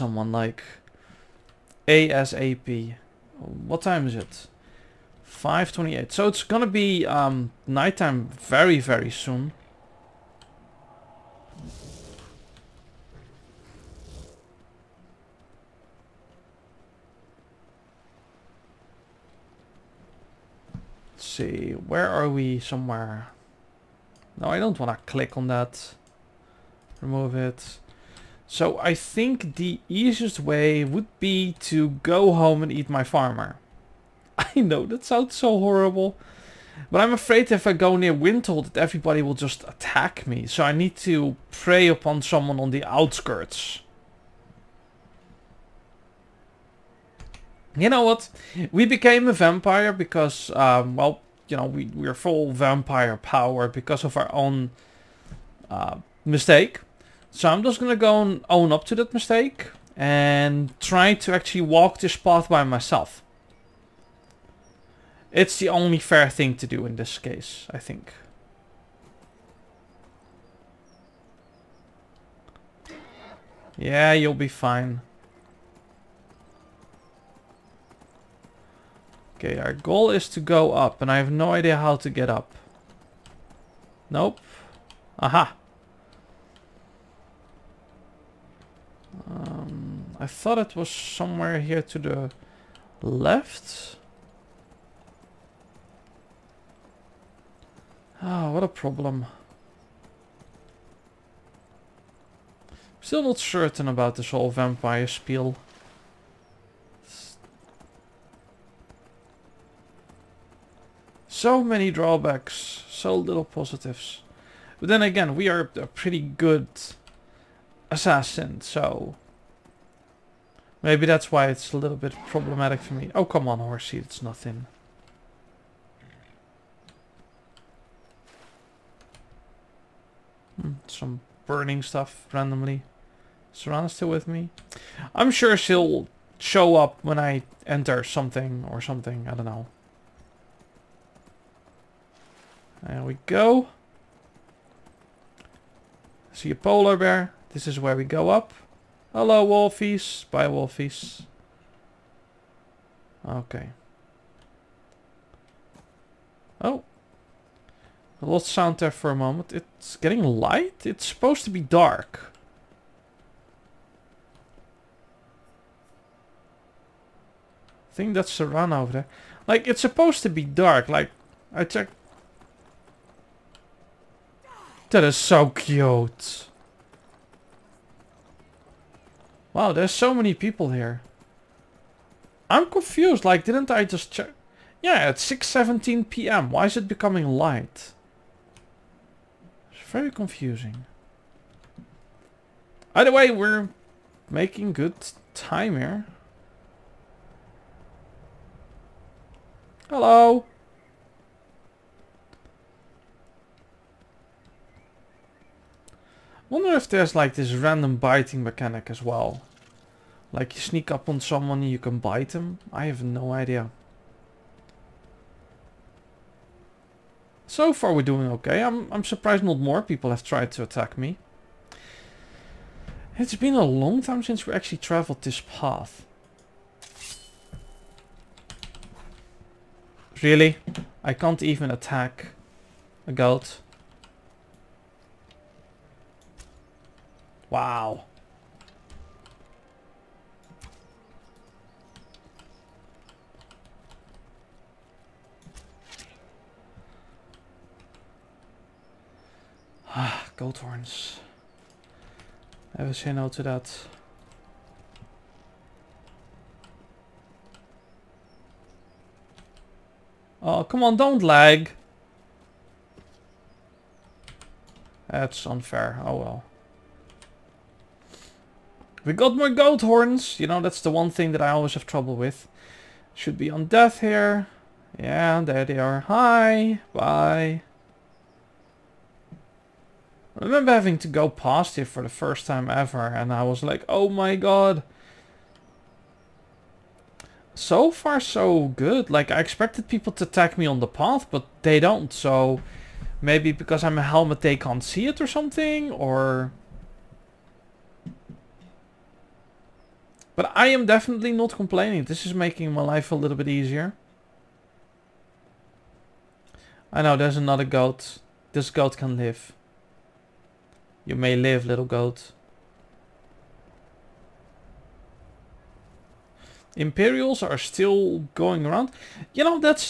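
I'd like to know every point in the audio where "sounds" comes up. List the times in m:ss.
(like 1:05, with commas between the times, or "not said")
0:35, 2:38.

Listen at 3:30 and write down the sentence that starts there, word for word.
Like you sneak up on someone and you can bite them.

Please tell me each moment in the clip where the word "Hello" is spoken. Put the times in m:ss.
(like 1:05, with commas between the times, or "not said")
2:29, 3:19.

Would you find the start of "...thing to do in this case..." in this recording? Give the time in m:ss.
1:06.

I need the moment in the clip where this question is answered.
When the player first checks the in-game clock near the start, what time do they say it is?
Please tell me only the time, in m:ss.
0:05.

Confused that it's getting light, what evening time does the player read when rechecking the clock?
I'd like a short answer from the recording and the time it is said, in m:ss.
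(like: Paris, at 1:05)
6:17 p.m., at 3:05.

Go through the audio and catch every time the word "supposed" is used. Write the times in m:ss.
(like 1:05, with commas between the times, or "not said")
2:41, 2:49.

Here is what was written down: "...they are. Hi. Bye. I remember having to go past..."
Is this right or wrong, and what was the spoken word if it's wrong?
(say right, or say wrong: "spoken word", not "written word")
right.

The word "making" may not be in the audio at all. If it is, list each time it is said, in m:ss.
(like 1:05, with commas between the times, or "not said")
3:14, 5:02.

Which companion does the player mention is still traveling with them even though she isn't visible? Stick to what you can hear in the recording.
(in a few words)
Serana.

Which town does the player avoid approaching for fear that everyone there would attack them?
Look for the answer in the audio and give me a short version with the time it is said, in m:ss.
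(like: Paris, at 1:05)
Winterhold, at 0:38.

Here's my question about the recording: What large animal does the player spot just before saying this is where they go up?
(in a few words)
A polar bear.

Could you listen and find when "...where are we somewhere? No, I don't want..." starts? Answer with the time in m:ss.
0:21.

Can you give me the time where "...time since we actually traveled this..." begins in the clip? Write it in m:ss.
3:44.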